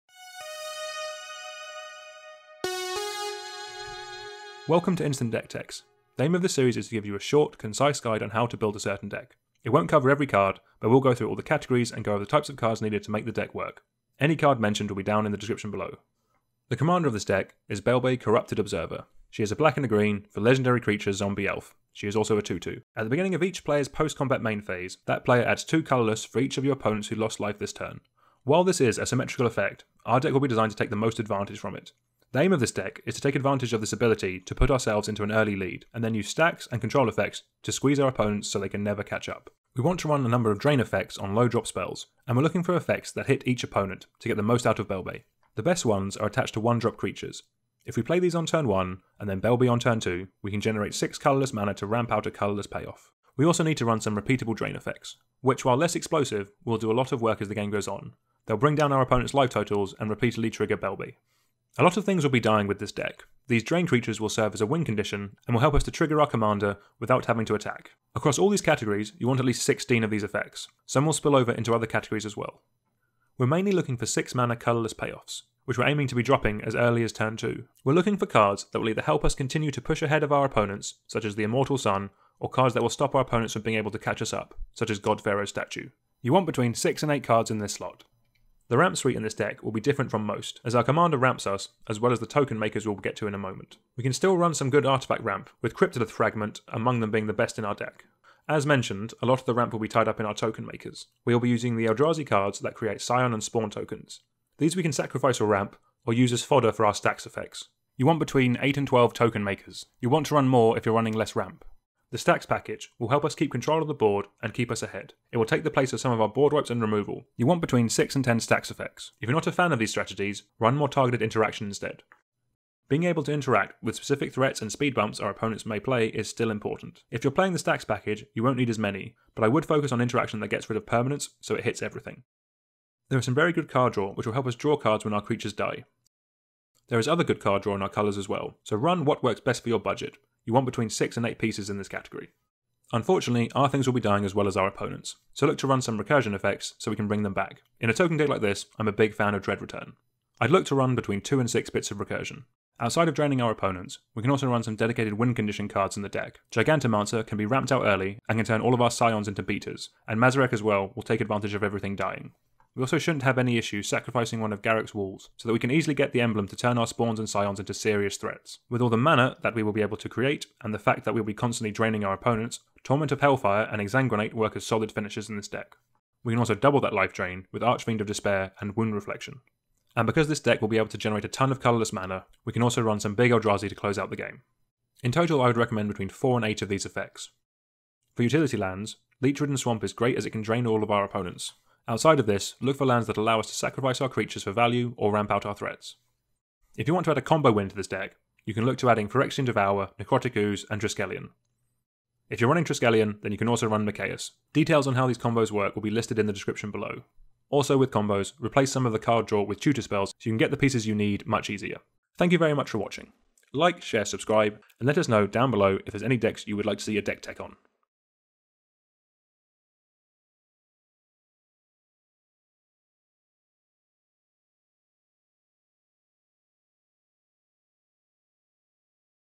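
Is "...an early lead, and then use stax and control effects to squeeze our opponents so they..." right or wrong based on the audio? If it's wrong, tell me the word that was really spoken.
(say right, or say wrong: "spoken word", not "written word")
right.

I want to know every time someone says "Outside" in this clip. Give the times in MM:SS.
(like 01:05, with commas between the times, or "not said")
02:32, 03:11.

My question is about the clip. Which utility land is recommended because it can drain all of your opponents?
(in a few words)
Leech Ridden Swamp.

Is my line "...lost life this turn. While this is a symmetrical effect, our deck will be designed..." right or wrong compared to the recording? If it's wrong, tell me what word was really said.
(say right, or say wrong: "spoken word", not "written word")
right.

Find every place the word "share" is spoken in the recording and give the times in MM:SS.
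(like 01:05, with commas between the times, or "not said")
03:33.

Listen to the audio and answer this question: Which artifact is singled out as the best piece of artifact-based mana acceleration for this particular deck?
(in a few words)
Cryptolith Fragment.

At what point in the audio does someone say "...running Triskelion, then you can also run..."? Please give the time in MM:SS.
03:22.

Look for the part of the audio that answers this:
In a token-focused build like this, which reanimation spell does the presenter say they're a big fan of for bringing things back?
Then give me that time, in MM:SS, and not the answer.
02:29.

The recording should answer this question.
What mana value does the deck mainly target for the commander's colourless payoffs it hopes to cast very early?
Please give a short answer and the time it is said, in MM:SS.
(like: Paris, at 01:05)
6, at 01:14.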